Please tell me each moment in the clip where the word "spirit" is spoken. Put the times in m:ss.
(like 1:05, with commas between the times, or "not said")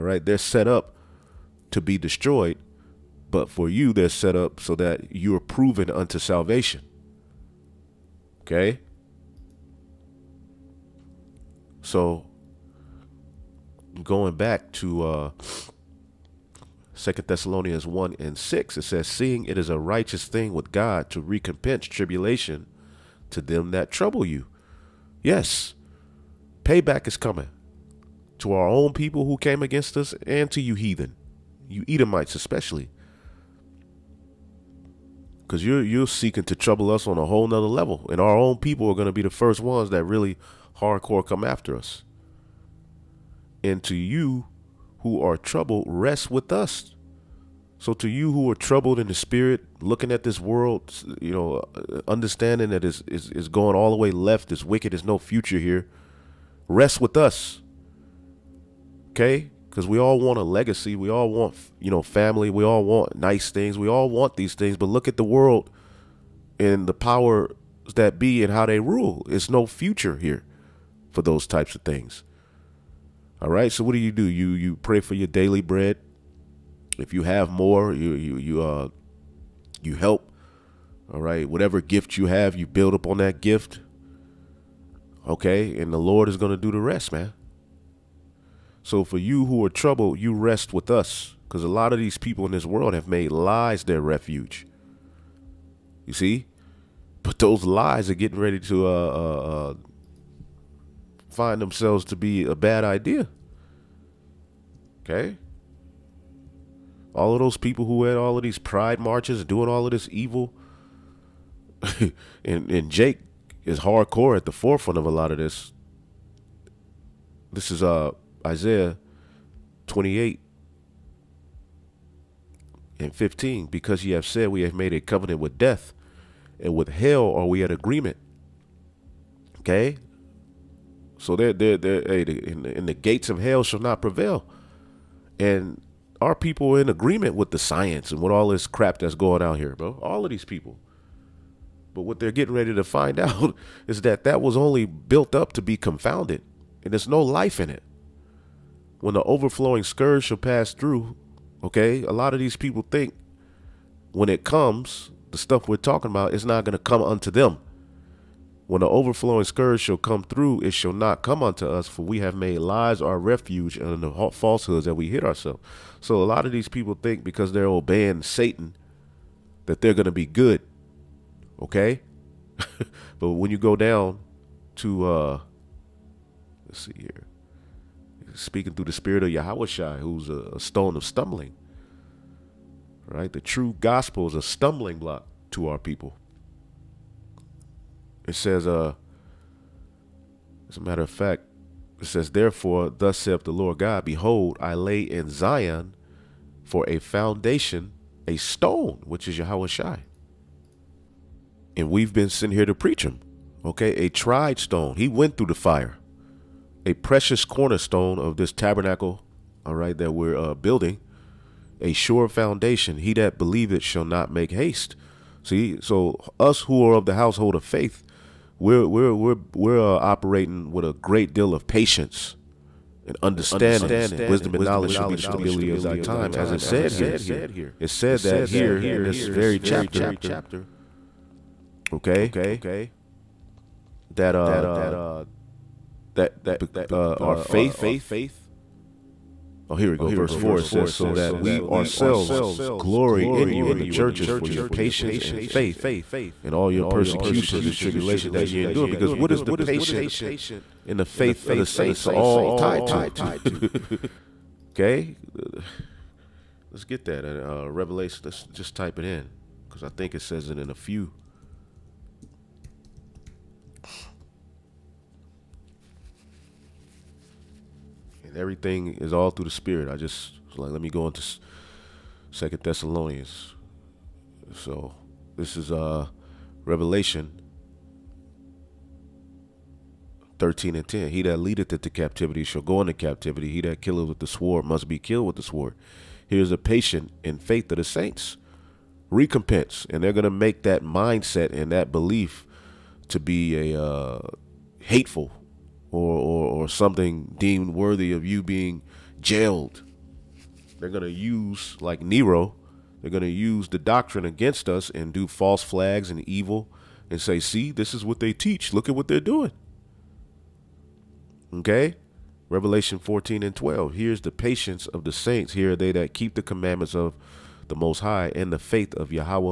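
0:49, 2:58, 4:29.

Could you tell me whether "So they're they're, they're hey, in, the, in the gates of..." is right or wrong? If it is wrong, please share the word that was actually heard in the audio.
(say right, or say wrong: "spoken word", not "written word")
right.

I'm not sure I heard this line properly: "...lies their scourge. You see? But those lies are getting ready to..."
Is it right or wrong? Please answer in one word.
wrong.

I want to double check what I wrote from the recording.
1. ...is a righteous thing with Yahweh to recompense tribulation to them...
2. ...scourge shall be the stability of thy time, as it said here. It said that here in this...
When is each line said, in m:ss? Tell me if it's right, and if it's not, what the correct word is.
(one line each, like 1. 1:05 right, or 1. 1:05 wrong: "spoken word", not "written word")
1. 0:19 wrong: "God", not "Yahweh"
2. 3:44 wrong: "knowledge", not "scourge".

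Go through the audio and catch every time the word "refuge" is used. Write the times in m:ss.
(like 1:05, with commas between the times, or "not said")
1:33, 2:43.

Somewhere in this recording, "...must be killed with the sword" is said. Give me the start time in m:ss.
4:44.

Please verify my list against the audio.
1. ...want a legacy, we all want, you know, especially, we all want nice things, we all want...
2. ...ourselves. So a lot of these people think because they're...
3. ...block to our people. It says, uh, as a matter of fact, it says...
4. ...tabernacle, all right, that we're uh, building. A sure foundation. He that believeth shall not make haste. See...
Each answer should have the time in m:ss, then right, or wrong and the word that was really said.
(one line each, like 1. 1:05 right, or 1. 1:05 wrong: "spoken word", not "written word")
1. 1:00 wrong: "family", not "especially"
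2. 2:45 right
3. 3:04 right
4. 3:28 right.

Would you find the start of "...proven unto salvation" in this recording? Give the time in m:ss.
0:05.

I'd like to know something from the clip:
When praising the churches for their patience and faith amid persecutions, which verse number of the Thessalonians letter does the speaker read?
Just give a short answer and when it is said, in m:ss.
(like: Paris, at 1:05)
Verse 4, at 4:00.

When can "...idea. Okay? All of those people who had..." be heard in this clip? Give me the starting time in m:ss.
1:42.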